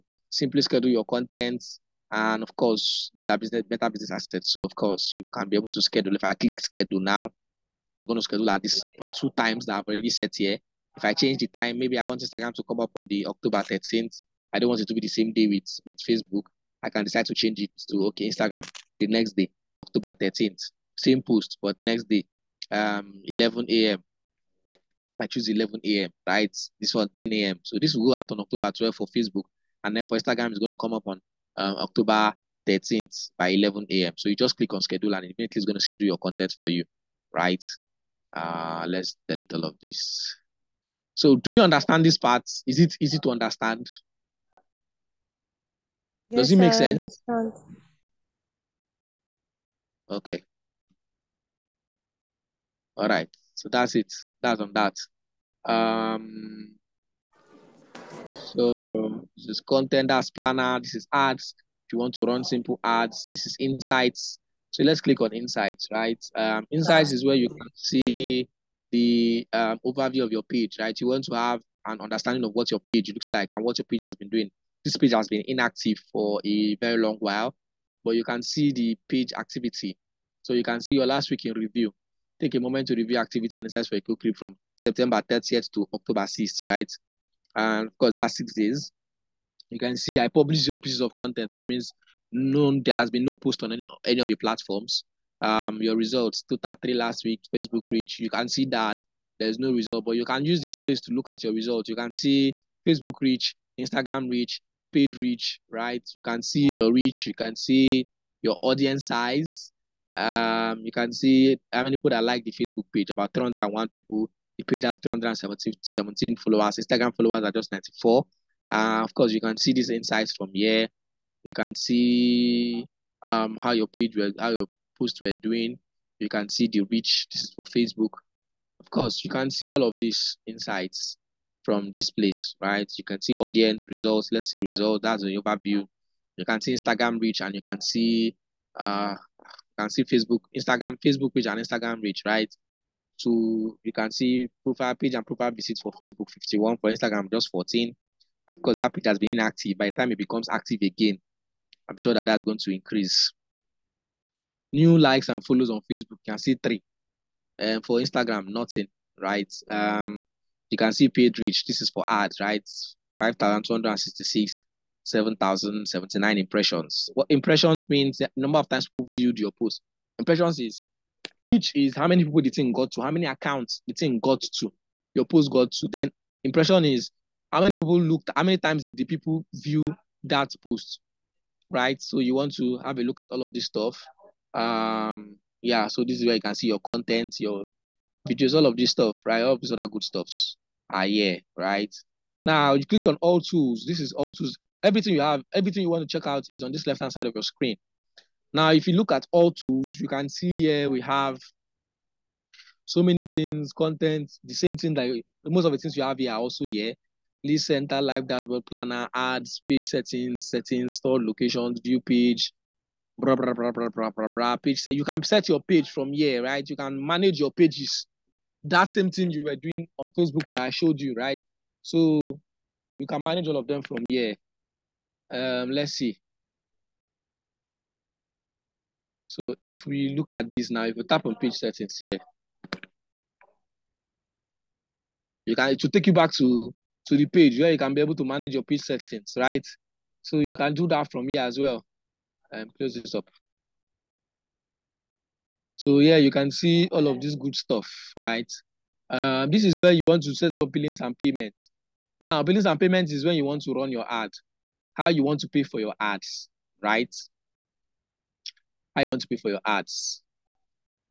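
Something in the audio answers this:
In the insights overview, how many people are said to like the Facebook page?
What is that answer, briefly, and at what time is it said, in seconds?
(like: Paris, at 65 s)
301, at 113 s.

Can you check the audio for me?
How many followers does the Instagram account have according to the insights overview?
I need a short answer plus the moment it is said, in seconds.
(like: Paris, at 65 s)
94, at 116 s.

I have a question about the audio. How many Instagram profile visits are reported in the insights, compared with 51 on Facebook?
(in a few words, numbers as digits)
14.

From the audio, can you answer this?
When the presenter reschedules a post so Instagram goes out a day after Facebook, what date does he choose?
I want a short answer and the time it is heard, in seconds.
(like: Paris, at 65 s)
October 13th, at 31 s.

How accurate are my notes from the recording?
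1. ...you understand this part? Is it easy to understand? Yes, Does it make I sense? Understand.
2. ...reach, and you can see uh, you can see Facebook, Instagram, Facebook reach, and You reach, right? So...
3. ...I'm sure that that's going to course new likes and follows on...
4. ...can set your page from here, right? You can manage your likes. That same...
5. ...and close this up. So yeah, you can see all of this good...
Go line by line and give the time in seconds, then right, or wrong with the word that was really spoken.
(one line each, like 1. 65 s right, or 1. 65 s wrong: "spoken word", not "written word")
1. 41 s right
2. 137 s wrong: "Instagram", not "You"
3. 151 s wrong: "increase", not "course"
4. 215 s wrong: "pages", not "likes"
5. 242 s right.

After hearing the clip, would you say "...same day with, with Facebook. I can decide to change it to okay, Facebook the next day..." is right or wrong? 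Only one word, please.
wrong.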